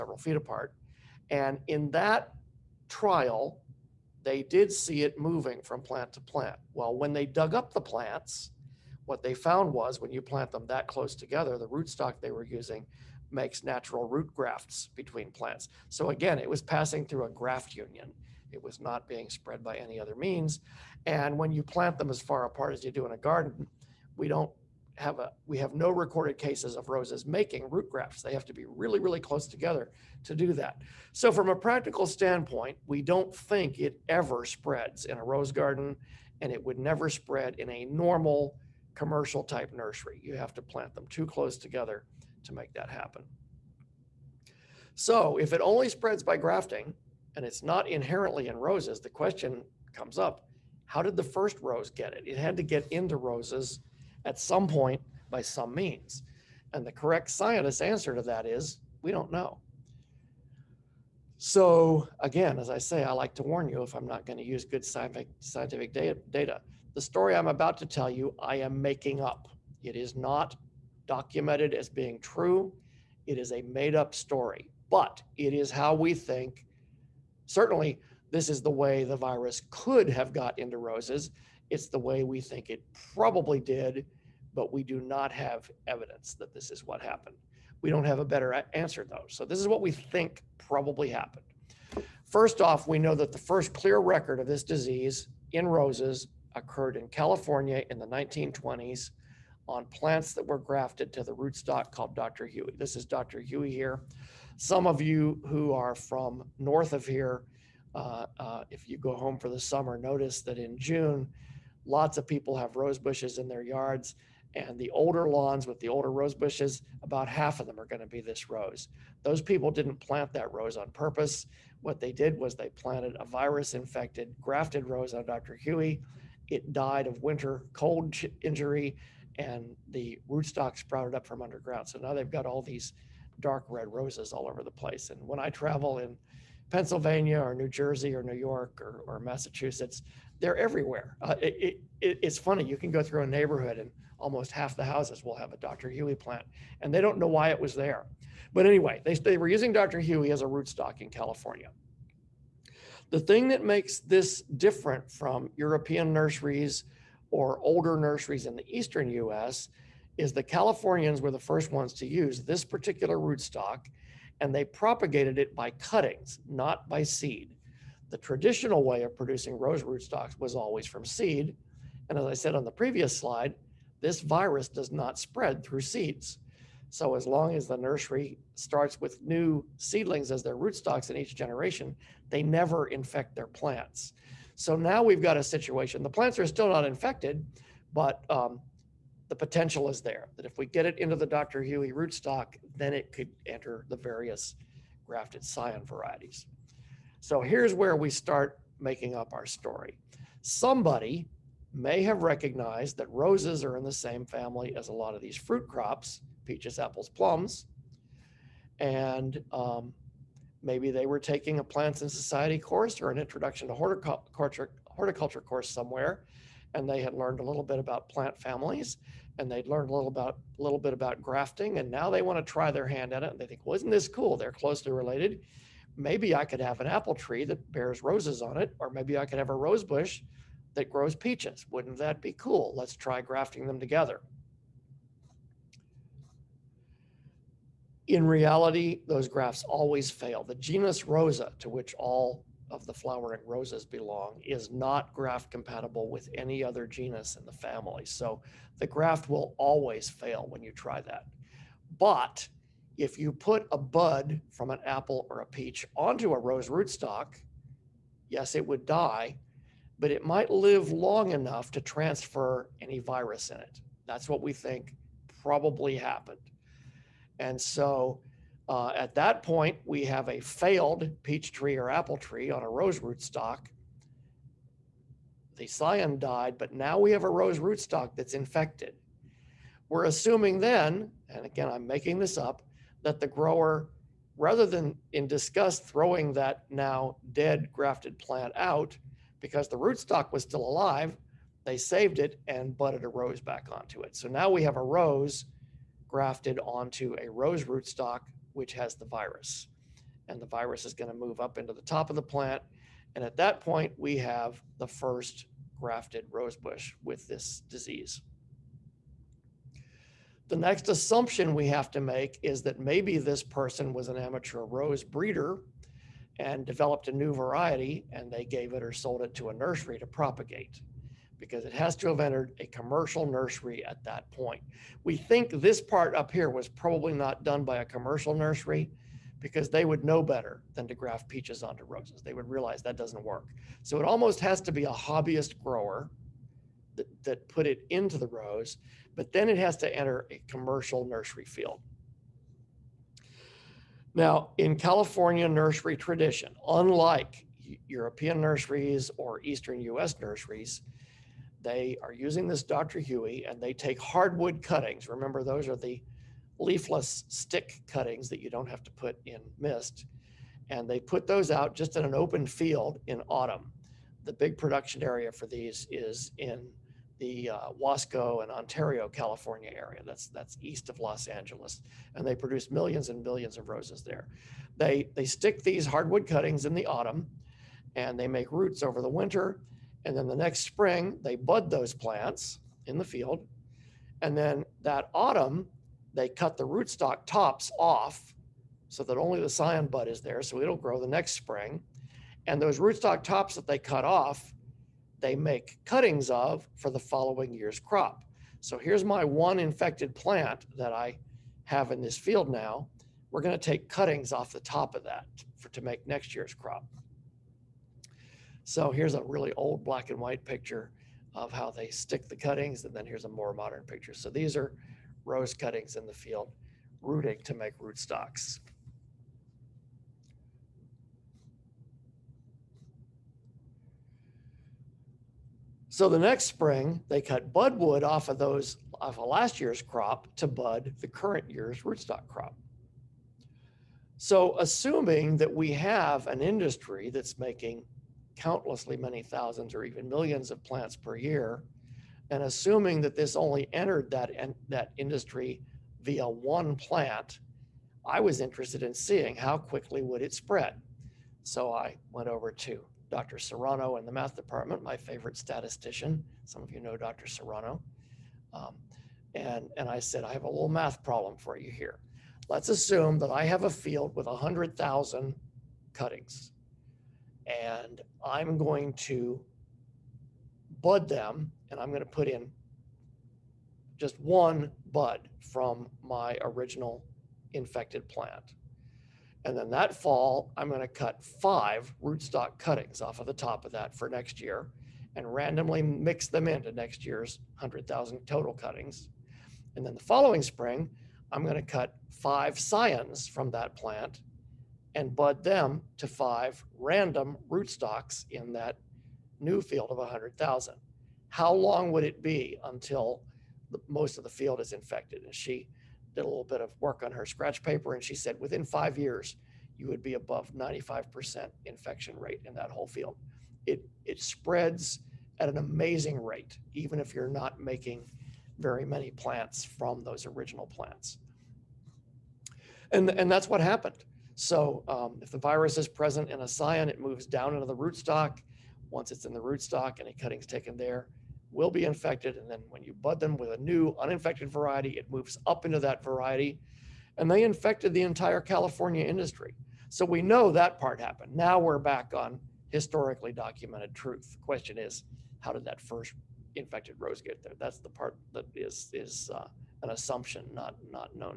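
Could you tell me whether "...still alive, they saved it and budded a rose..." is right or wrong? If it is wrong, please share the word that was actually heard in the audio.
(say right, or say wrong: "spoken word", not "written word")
right.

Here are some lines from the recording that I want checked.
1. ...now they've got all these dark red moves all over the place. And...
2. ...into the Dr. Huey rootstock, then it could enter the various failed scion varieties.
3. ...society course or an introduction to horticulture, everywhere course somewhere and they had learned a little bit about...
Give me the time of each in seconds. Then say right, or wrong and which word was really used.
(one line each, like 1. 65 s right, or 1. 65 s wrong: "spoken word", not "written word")
1. 131 s wrong: "roses", not "moves"
2. 190 s wrong: "grafted", not "failed"
3. 212 s wrong: "horticulture", not "everywhere".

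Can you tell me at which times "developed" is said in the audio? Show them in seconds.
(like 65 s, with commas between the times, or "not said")
316 s.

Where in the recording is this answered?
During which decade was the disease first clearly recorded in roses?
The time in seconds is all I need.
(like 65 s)
98 s.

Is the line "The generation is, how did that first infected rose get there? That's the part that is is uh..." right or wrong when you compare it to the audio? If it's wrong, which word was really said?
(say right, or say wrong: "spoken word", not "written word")
wrong: "question", not "generation".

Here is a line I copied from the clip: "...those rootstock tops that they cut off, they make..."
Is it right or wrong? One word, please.
right.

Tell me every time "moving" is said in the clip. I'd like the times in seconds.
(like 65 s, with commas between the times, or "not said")
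5 s.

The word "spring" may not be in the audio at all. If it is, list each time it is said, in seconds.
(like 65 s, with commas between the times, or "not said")
380 s, 391 s, 426 s, 490 s.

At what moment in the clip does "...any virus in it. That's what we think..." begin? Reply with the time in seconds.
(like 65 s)
262 s.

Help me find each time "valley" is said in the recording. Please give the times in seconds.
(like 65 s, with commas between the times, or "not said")
not said.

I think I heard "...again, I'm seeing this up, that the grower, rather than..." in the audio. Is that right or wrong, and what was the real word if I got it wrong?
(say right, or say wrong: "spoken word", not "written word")
wrong: "making", not "seeing".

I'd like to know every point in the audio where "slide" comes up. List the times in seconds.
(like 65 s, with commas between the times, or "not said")
173 s.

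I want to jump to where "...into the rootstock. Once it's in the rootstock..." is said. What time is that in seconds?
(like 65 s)
527 s.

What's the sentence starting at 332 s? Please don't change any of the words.
They would realize that doesn't work.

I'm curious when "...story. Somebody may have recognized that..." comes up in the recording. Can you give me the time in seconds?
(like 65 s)
199 s.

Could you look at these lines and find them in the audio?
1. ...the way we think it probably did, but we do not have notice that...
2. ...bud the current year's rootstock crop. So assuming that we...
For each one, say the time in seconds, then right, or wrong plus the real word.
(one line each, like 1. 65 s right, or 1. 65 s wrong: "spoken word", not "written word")
1. 81 s wrong: "evidence", not "notice"
2. 430 s right.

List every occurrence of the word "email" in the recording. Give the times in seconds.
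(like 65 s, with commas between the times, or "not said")
not said.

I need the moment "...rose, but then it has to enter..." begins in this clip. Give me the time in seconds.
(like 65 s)
338 s.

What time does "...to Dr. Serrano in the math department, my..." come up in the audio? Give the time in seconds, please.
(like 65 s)
452 s.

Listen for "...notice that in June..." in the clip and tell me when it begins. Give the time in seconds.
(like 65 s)
109 s.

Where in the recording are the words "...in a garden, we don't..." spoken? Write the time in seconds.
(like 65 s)
23 s.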